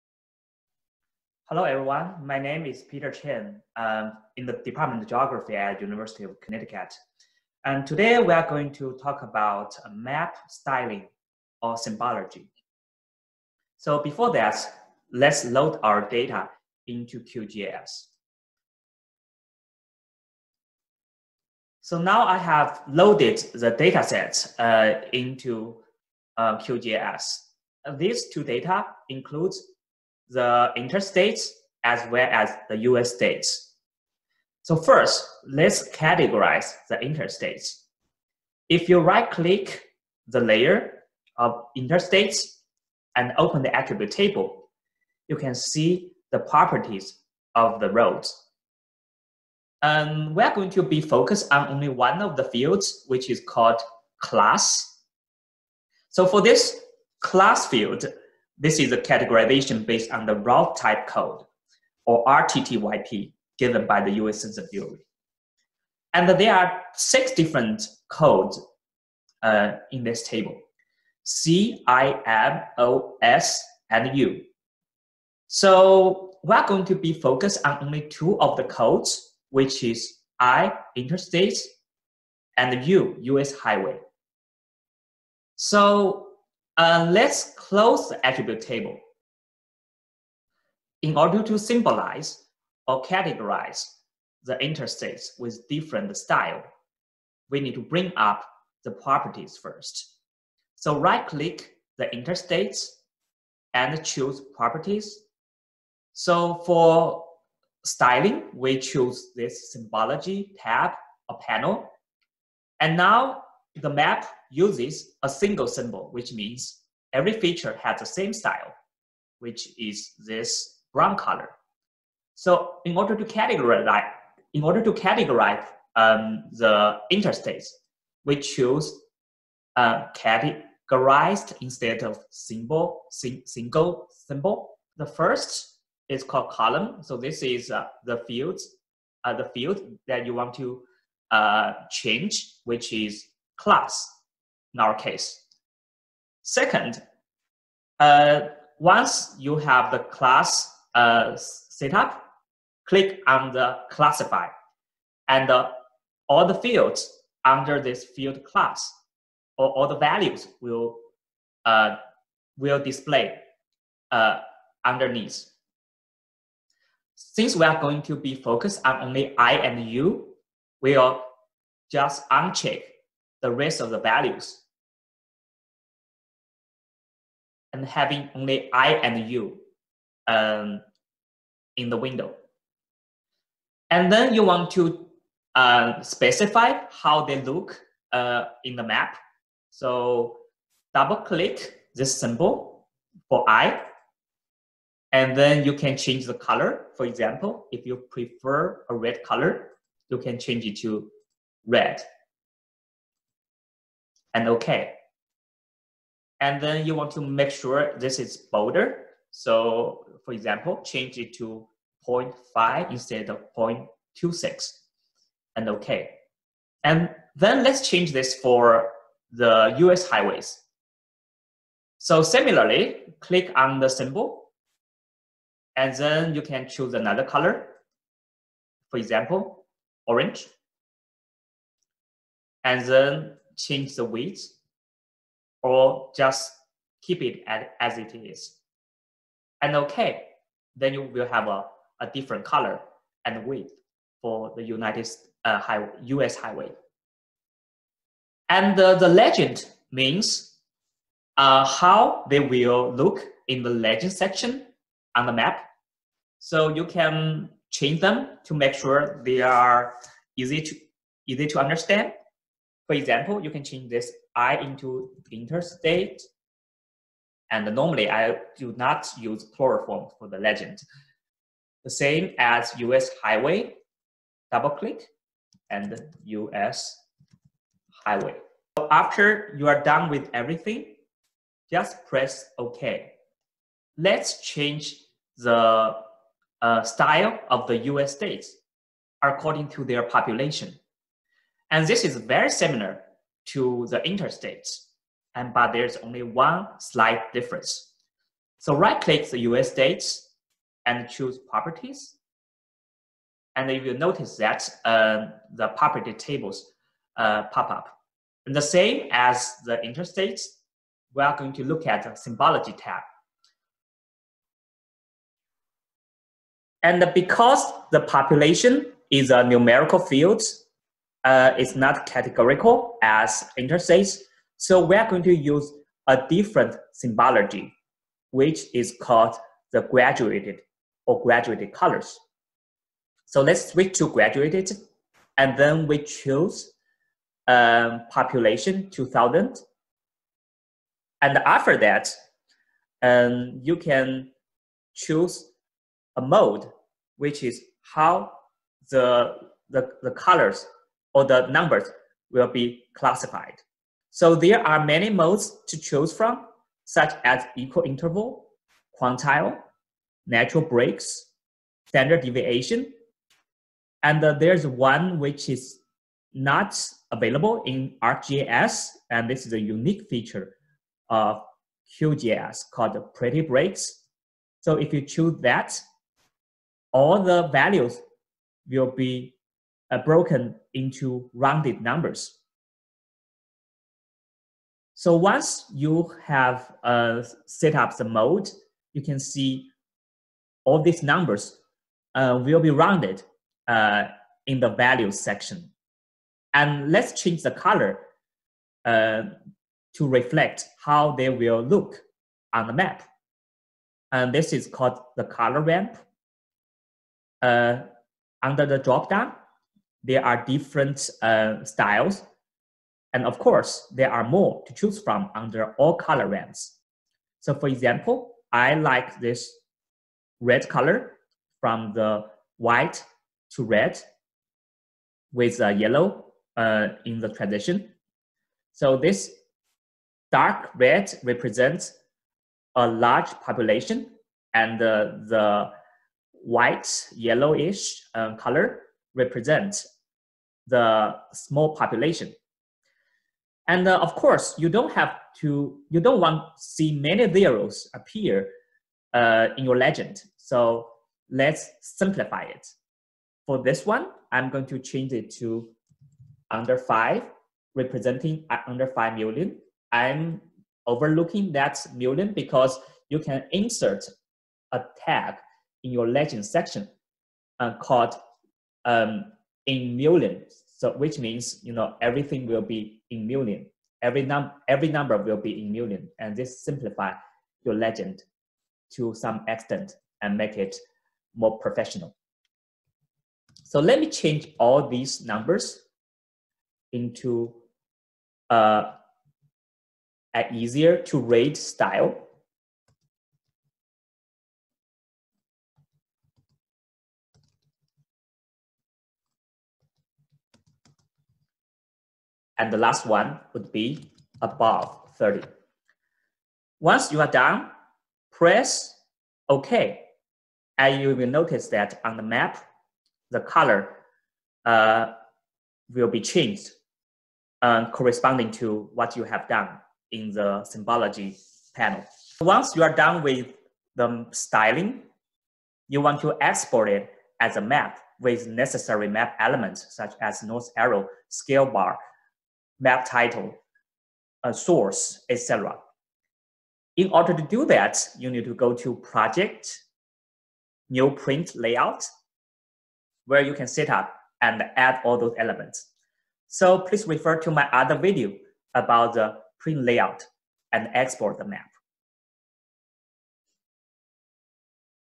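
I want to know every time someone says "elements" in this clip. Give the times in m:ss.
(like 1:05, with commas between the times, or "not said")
8:49, 9:05.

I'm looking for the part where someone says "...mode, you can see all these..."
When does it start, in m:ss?
6:28.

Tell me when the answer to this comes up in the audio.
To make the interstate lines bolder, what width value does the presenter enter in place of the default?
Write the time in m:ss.
3:32.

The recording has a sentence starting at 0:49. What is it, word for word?
And um, we're going to be focused on only one of the fields, which is called class.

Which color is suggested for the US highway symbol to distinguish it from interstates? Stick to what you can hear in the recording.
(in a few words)
orange.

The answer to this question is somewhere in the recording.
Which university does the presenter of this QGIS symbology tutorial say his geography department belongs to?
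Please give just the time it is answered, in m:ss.
0:05.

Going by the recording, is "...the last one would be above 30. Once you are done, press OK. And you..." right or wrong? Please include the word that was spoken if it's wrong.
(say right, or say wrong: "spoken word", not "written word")
right.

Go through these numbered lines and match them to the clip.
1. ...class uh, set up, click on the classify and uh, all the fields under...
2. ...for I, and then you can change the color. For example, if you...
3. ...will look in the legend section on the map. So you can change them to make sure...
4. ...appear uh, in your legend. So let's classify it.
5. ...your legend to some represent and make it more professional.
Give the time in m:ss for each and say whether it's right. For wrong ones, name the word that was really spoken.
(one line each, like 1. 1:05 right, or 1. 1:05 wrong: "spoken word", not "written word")
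1. 2:29 right
2. 3:13 right
3. 4:12 right
4. 7:27 wrong: "simplify", not "classify"
5. 7:57 wrong: "extent", not "represent".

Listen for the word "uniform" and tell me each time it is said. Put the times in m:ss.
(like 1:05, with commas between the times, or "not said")
not said.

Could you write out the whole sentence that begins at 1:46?
So for styling, we choose this symbology tab or panel.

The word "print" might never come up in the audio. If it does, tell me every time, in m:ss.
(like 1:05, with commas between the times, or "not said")
9:01, 9:09.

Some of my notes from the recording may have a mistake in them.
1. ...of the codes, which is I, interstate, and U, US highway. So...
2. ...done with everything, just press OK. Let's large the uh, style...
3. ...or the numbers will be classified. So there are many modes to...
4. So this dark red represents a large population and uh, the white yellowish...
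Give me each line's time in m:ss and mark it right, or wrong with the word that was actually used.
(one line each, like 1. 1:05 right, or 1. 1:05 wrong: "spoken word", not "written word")
1. 1:18 right
2. 4:39 wrong: "change", not "large"
3. 5:51 right
4. 7:08 right.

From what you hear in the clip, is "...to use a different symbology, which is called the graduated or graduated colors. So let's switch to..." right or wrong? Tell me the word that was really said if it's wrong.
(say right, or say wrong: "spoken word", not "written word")
right.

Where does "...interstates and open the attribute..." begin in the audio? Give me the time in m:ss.
0:41.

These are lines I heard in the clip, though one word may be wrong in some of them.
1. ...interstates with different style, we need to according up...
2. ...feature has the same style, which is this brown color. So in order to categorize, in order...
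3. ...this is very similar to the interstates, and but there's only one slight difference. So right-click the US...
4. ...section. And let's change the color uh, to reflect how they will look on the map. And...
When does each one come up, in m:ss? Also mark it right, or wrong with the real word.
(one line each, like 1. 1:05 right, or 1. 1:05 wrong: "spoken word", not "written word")
1. 1:34 wrong: "bring", not "according"
2. 1:57 right
3. 4:51 right
4. 6:35 right.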